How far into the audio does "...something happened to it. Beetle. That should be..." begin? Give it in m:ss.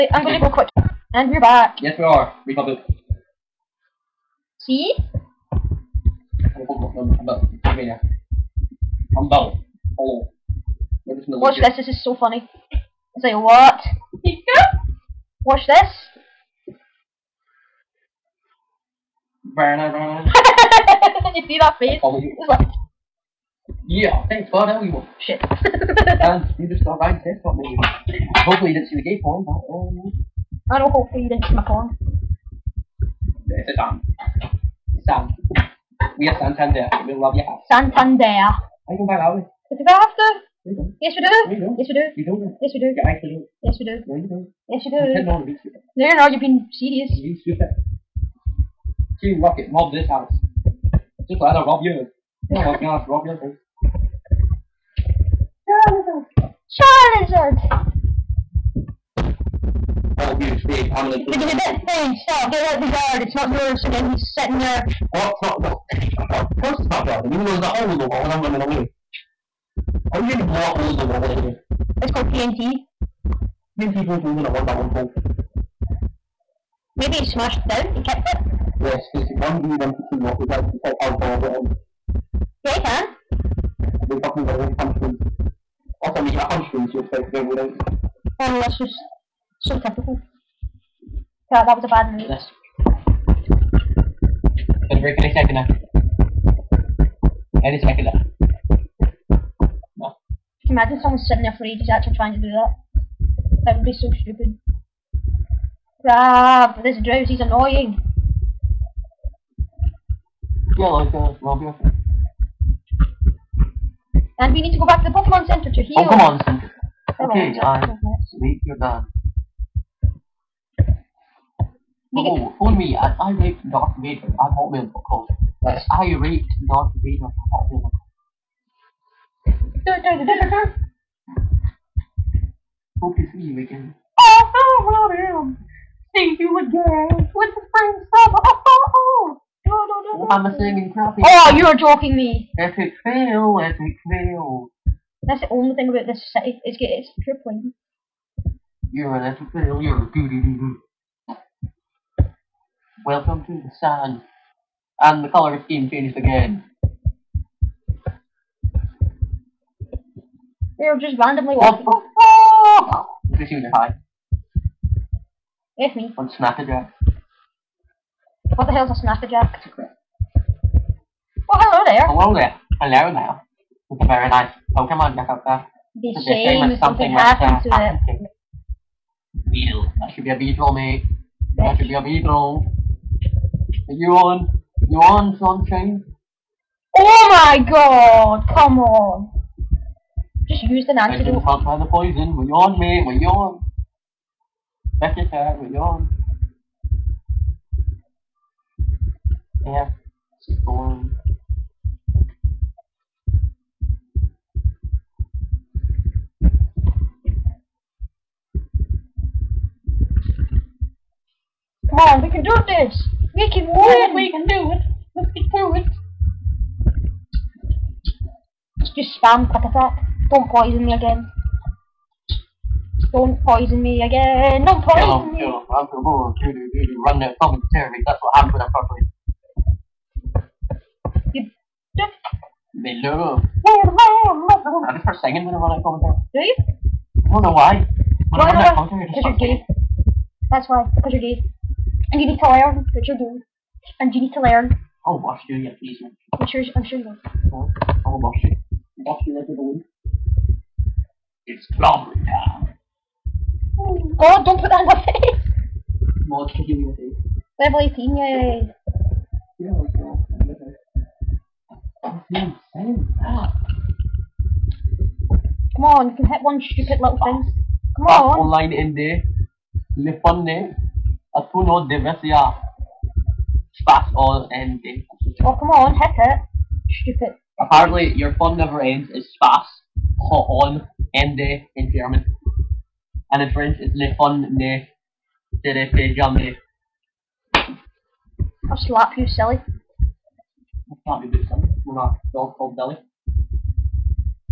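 2:56.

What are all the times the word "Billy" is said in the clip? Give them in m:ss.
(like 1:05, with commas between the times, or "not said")
4:52.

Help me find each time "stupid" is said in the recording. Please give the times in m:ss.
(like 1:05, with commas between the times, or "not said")
0:47, 1:44, 4:26, 4:36.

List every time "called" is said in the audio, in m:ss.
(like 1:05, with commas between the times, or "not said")
1:12, 4:52.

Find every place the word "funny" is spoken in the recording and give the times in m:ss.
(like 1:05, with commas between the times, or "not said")
0:12, 1:35.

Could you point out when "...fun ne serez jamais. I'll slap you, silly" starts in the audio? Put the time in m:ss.
4:44.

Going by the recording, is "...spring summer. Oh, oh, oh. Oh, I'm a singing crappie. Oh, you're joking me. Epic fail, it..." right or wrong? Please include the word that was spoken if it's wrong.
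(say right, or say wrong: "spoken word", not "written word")
right.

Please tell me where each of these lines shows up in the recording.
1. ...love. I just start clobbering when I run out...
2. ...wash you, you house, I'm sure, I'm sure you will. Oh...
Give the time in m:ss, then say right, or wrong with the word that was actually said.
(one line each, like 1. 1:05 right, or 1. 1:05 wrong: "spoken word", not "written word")
1. 3:53 wrong: "singing", not "clobbering"
2. 4:05 wrong: "please", not "house".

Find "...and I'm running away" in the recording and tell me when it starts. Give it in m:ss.
1:08.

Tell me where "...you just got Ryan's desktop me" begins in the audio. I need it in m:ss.
0:26.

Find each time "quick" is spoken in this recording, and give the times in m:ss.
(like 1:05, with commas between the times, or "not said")
0:00, 3:39.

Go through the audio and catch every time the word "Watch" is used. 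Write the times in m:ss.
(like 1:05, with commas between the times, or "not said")
0:11, 0:15.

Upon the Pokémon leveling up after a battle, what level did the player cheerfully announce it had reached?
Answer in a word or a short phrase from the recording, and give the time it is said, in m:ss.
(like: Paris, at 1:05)
18, at 4:17.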